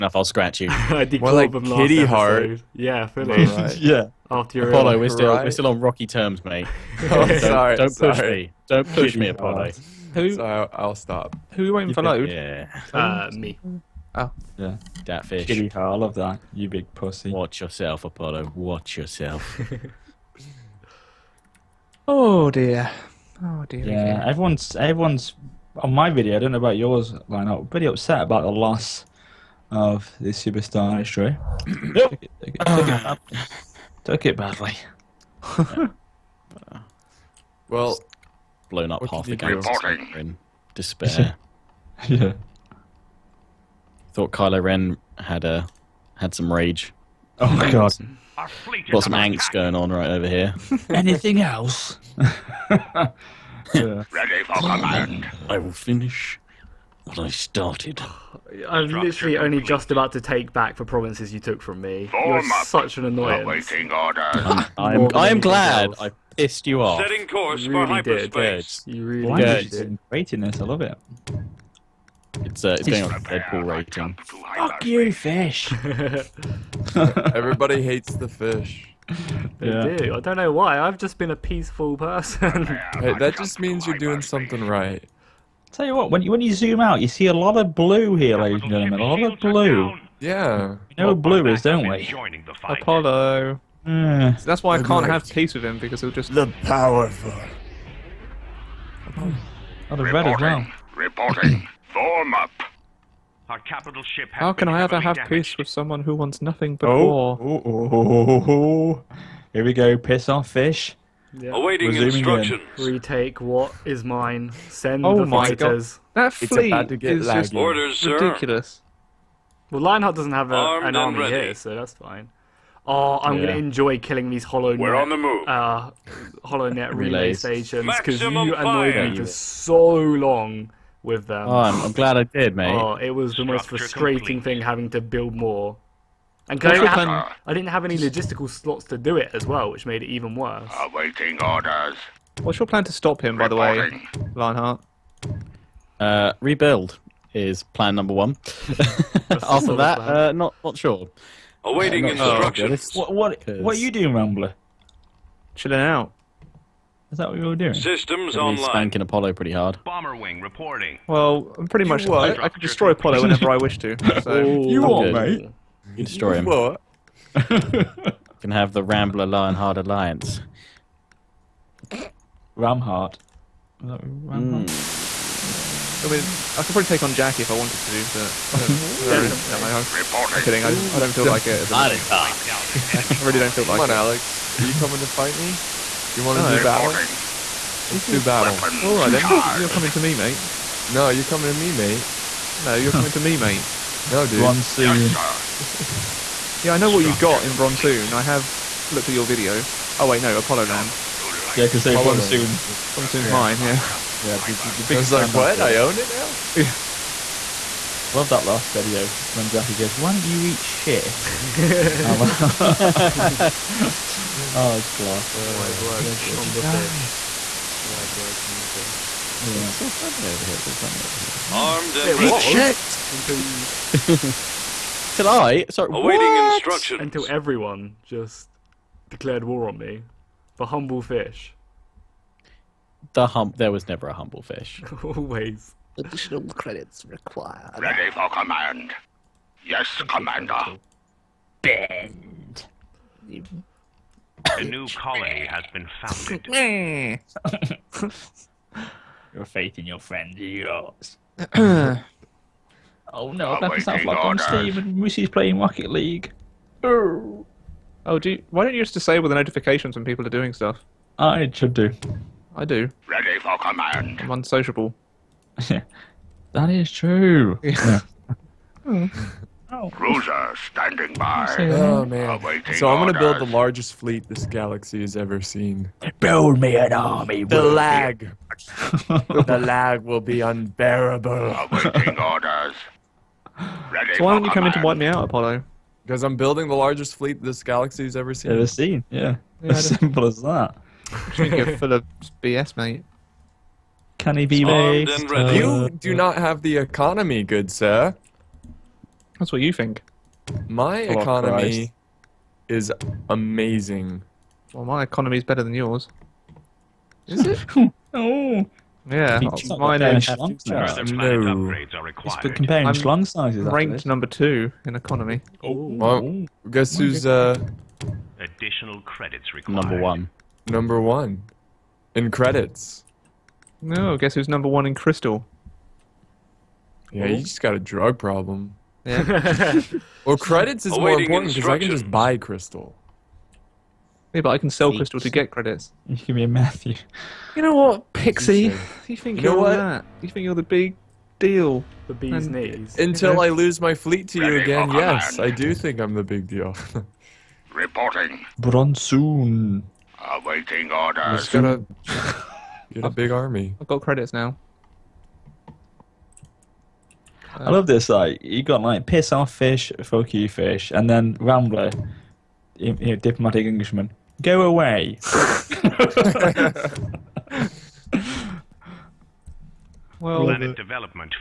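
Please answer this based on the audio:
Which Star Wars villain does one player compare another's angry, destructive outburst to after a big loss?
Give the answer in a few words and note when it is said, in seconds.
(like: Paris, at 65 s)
Kylo Ren, at 44 s.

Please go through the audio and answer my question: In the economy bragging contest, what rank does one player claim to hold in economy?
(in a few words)
Number 2.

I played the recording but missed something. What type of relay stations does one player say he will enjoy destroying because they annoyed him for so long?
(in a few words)
HoloNet relay stations.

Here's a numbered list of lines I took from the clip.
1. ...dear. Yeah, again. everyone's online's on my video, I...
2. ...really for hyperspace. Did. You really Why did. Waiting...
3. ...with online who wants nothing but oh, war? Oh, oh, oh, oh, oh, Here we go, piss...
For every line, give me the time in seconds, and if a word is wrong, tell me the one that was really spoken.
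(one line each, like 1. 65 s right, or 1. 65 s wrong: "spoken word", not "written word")
1. 23 s wrong: "everyone", not "online"
2. 67 s right
3. 105 s wrong: "someone", not "online".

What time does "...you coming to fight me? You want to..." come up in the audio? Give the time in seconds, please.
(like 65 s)
184 s.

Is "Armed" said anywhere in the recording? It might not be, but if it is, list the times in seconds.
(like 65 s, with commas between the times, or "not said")
221 s, 294 s.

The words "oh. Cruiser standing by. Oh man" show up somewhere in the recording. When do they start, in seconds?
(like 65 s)
268 s.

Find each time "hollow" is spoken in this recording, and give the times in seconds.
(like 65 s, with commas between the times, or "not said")
124 s.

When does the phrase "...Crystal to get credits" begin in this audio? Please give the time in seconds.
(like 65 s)
334 s.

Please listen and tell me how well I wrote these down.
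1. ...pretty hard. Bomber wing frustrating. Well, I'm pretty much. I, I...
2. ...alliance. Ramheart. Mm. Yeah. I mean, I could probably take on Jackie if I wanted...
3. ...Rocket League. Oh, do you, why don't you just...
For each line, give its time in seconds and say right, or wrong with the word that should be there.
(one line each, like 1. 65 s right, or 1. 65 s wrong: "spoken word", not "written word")
1. 159 s wrong: "reporting", not "frustrating"
2. 169 s right
3. 255 s right.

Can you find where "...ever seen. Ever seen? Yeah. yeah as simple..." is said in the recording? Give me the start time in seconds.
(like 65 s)
288 s.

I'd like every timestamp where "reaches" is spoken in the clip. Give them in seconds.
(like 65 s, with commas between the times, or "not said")
not said.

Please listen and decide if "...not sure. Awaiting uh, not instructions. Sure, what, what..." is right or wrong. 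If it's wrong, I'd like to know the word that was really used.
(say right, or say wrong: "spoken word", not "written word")
right.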